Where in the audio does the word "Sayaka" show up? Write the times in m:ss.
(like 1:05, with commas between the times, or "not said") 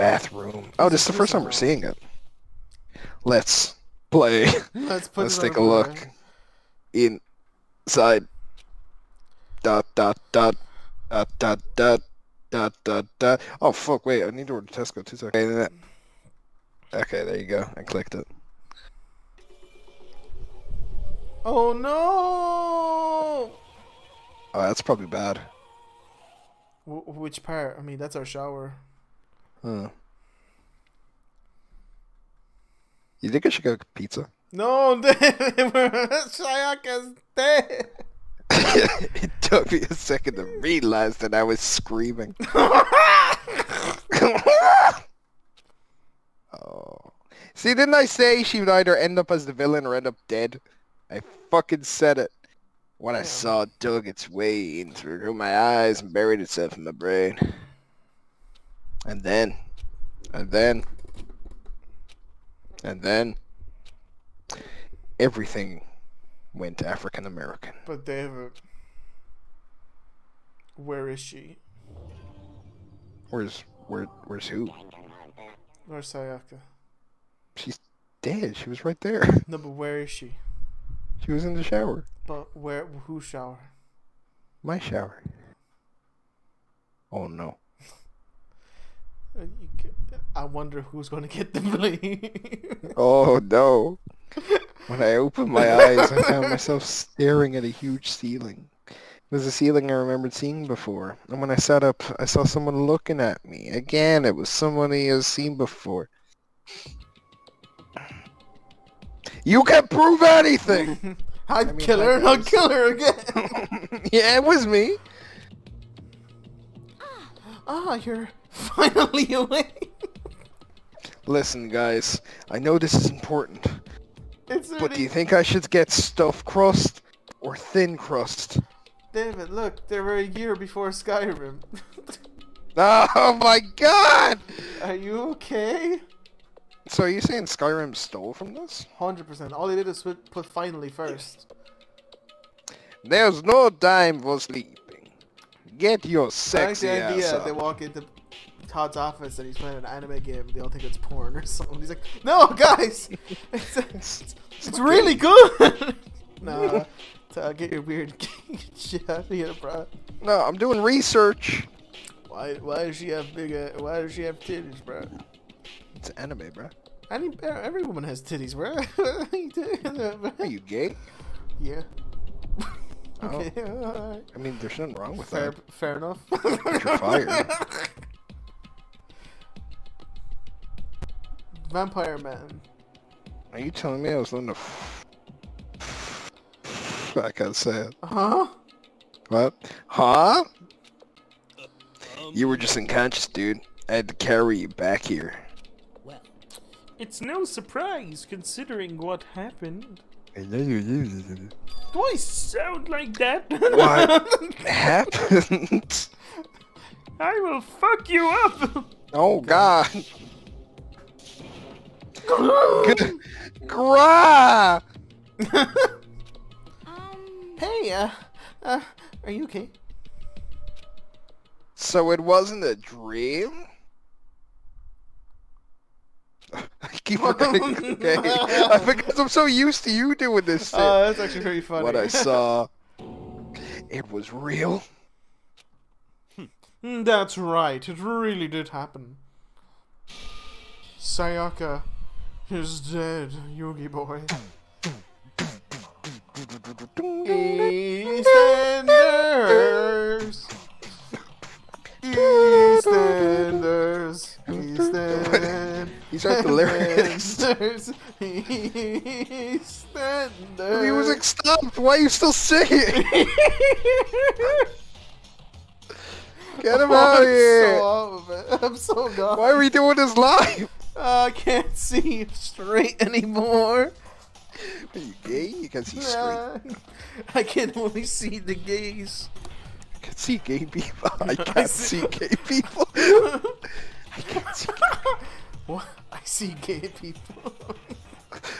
0:36, 1:16, 4:00.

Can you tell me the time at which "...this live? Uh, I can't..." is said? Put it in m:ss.
4:29.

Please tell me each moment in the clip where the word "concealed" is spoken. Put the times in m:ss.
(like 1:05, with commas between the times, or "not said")
not said.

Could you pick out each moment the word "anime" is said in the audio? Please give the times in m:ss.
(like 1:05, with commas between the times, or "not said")
2:29, 2:46.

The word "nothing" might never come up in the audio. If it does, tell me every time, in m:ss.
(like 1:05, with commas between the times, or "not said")
2:54.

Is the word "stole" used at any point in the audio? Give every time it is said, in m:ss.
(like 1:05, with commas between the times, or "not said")
2:17.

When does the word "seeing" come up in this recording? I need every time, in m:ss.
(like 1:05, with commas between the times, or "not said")
0:01, 1:40.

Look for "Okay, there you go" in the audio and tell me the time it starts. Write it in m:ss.
0:16.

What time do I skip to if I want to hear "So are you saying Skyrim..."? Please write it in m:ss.
2:16.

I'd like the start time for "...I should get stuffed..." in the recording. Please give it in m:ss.
2:05.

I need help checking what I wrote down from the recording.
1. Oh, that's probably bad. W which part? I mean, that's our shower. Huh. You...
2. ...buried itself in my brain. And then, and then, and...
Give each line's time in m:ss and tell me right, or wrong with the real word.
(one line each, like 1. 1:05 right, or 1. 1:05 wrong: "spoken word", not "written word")
1. 0:24 right
2. 0:56 right.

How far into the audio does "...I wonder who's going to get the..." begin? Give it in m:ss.
1:30.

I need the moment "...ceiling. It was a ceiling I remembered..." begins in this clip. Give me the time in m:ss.
1:38.